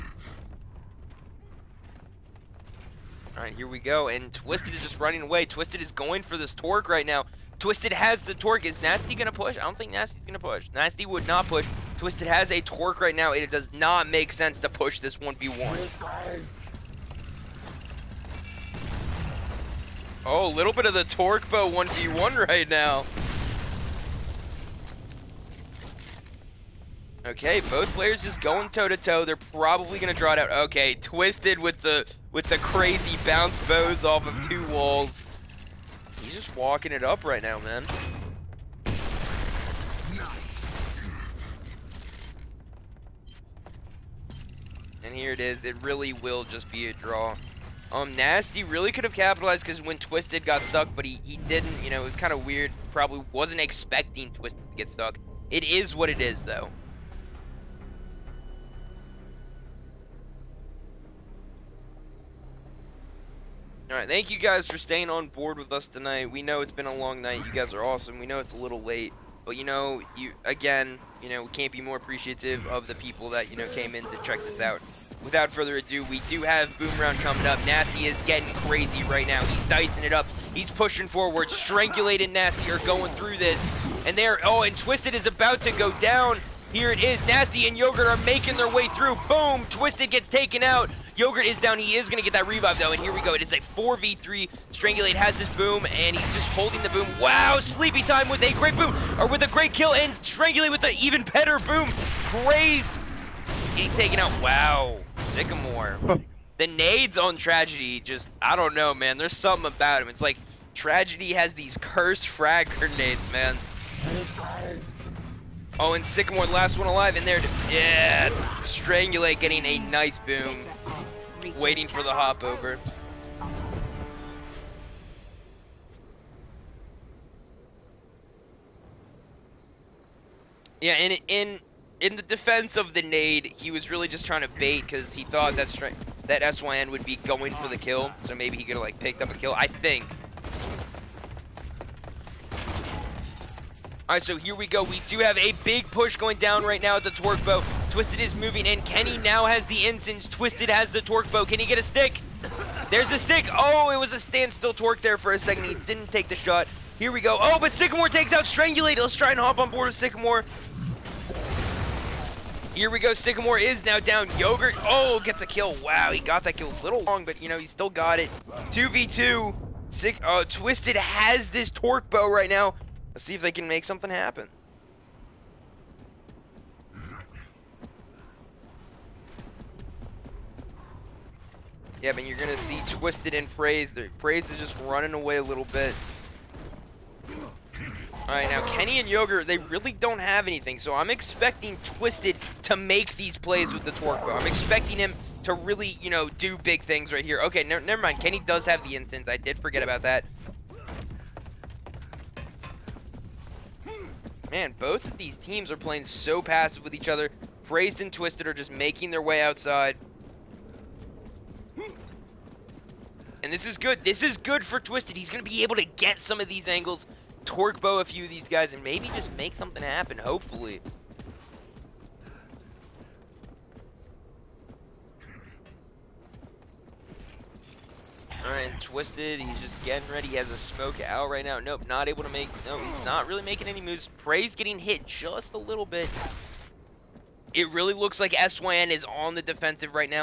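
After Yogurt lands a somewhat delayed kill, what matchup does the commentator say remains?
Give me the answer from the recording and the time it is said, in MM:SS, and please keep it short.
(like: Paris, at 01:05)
2v2, at 02:48.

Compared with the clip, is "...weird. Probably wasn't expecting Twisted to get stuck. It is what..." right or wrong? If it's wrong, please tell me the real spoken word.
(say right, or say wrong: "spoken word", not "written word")
right.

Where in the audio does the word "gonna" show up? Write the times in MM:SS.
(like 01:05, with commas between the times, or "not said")
00:29, 03:02.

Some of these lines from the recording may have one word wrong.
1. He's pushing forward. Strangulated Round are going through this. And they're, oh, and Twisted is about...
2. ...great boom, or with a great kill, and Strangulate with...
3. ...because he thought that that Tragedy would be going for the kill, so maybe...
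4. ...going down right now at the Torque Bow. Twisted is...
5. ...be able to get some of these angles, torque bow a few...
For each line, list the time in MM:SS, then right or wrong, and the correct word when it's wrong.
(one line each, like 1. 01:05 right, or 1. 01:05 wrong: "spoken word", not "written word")
1. 01:20 wrong: "Nasty", not "Round"
2. 01:38 right
3. 02:14 wrong: "SYN", not "Tragedy"
4. 02:26 right
5. 03:35 right.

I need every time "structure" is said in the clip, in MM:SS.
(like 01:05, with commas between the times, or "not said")
not said.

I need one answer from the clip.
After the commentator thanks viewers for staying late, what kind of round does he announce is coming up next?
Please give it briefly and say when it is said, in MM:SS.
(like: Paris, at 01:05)
Boom Round, at 01:16.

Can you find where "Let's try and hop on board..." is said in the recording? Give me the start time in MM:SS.
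02:38.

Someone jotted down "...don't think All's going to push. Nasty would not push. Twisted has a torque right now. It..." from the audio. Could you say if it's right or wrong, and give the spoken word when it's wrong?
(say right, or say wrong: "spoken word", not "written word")
wrong: "Nasty", not "All".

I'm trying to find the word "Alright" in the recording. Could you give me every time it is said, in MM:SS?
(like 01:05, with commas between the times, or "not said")
01:03, 03:08, 03:48.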